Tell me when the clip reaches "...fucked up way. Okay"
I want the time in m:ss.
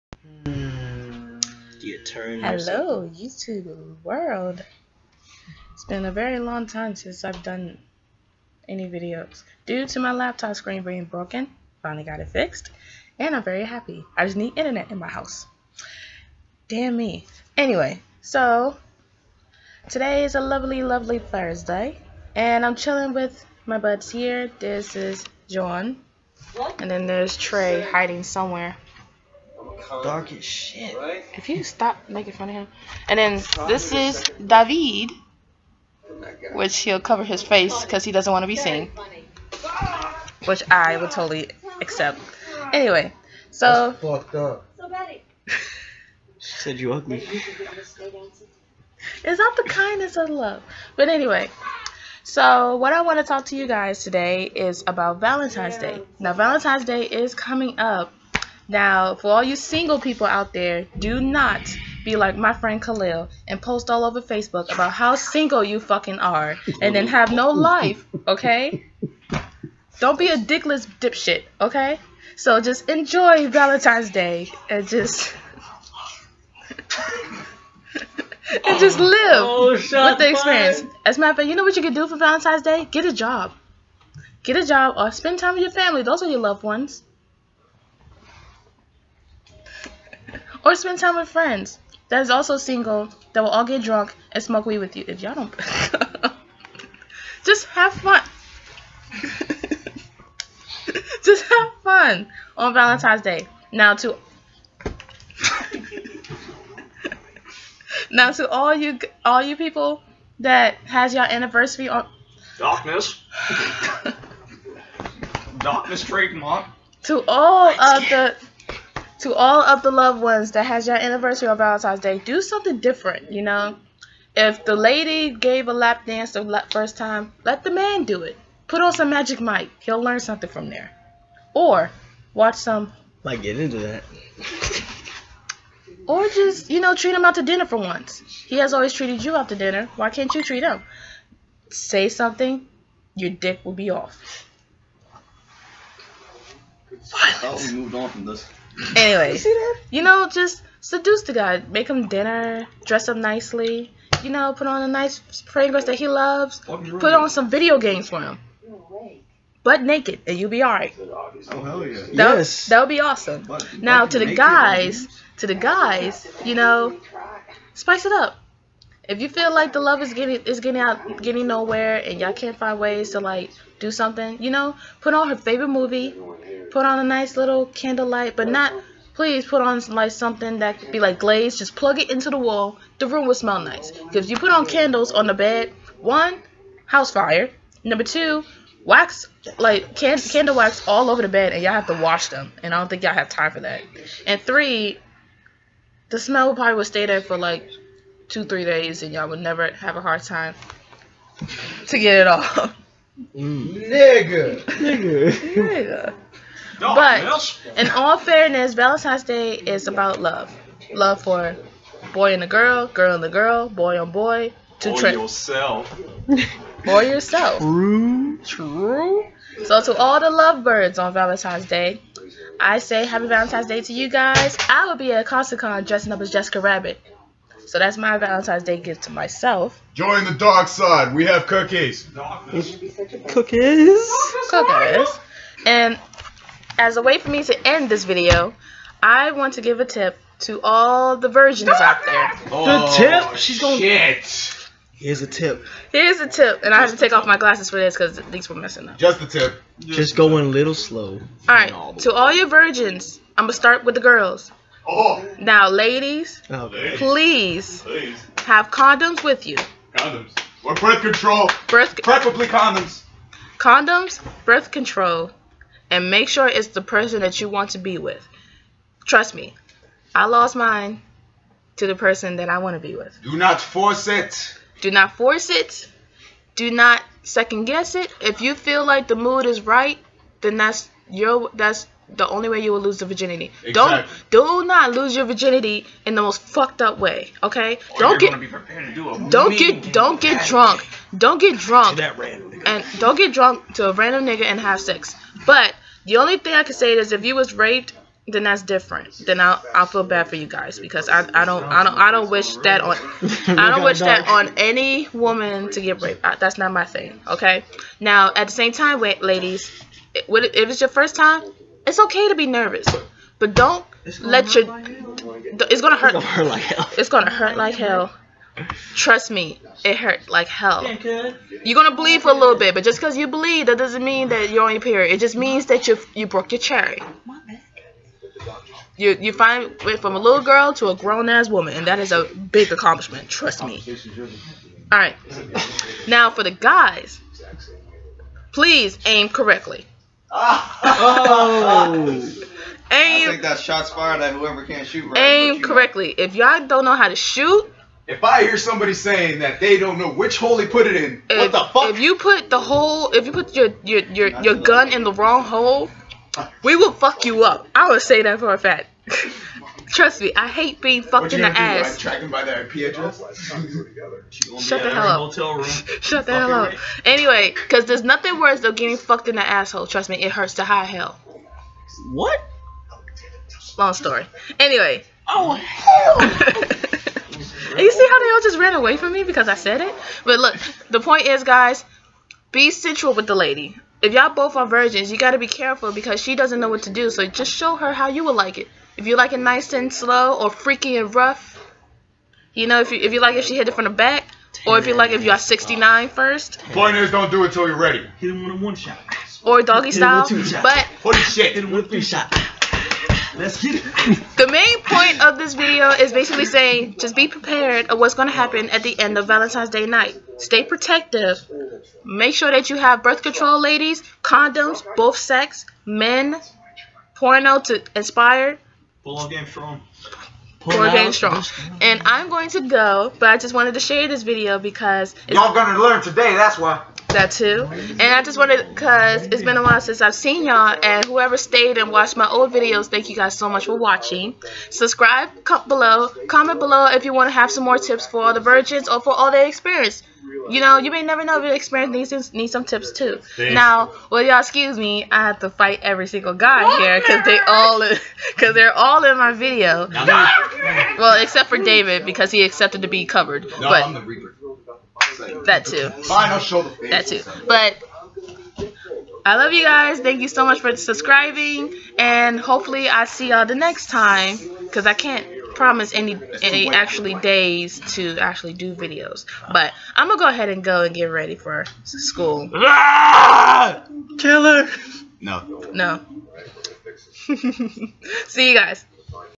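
4:46.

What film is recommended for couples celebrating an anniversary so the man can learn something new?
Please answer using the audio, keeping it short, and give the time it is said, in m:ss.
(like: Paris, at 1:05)
Magic Mike, at 2:09.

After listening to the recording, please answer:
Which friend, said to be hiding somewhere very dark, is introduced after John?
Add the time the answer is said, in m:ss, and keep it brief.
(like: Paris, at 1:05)
Trey, at 0:27.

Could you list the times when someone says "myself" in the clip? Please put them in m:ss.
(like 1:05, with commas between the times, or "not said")
3:49.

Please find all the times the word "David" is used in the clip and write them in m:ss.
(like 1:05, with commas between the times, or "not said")
0:34, 7:31.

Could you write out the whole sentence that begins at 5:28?
You you find went from a little girl to a grown ass woman, and that is a big accomplishment.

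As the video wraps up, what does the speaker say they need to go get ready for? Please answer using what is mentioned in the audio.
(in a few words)
school.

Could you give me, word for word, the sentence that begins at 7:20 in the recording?
You know, you may never know if your experience needs, needs some tips too.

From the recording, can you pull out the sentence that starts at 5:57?
I would say that for a fact.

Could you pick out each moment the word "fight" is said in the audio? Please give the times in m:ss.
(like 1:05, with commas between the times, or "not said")
7:25.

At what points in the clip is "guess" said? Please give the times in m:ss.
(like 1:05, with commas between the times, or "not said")
4:37.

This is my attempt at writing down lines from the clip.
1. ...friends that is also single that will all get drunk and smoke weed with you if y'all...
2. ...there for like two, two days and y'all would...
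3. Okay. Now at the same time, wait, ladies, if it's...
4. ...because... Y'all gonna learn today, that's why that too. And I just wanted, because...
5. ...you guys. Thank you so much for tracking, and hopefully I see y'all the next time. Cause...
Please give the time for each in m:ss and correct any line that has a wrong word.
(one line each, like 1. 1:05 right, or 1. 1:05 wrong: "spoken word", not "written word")
1. 1:31 right
2. 3:17 wrong: "three", not "two"
3. 5:07 right
4. 7:04 right
5. 7:39 wrong: "subscribing", not "tracking".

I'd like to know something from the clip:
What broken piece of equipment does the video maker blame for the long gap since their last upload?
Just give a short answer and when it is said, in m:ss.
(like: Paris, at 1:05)
laptop screen, at 0:10.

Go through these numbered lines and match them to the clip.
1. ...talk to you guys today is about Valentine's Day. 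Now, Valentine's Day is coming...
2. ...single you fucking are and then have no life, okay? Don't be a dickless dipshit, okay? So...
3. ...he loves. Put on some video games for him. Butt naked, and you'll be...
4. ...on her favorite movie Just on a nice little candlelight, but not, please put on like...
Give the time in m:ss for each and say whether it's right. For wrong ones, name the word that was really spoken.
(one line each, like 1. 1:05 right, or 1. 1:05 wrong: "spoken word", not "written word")
1. 0:53 right
2. 1:05 right
3. 2:35 right
4. 2:55 wrong: "Put", not "Just".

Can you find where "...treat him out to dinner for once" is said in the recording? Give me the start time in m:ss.
2:16.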